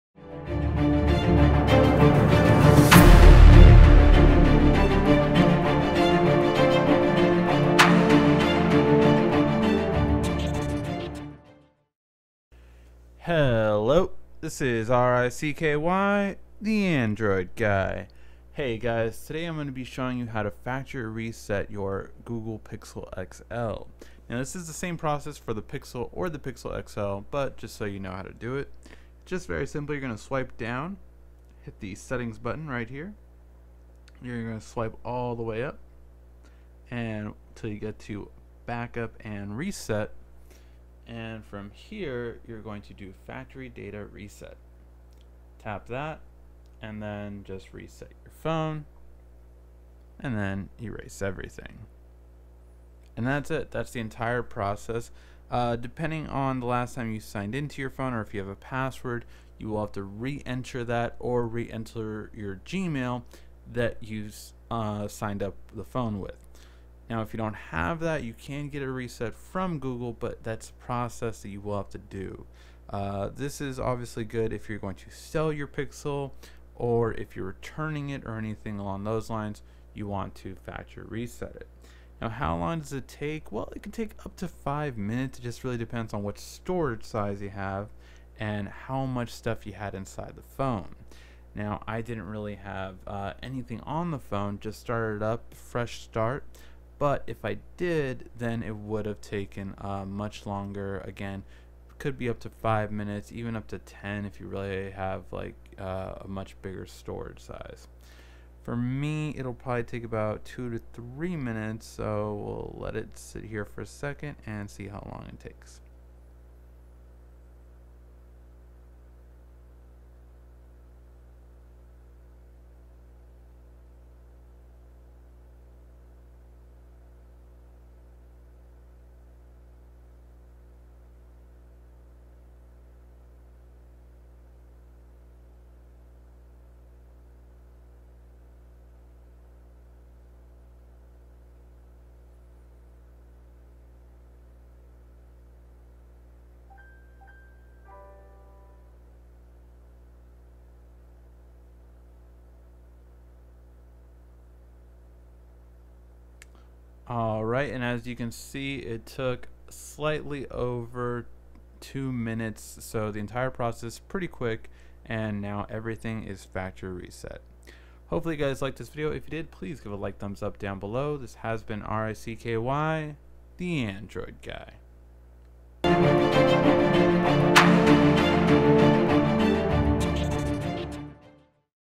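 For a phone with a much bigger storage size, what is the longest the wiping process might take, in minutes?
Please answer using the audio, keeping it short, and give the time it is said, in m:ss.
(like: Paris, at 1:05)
10, at 1:43.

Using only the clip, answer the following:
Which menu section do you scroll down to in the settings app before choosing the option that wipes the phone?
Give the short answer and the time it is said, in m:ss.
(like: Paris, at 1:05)
Backup and reset, at 0:38.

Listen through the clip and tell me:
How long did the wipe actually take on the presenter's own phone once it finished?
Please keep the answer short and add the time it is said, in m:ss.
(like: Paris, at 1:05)
Slightly over 2 minutes, at 2:39.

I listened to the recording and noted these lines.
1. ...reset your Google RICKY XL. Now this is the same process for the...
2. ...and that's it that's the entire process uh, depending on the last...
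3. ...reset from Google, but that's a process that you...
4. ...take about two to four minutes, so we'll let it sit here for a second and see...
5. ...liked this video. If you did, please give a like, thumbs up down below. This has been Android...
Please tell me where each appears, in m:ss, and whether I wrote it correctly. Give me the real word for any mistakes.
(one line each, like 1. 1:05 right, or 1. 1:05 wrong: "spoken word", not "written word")
1. 0:21 wrong: "Pixel", not "RICKY"
2. 0:53 right
3. 1:08 right
4. 1:49 wrong: "three", not "four"
5. 2:48 wrong: "RICKY", not "Android".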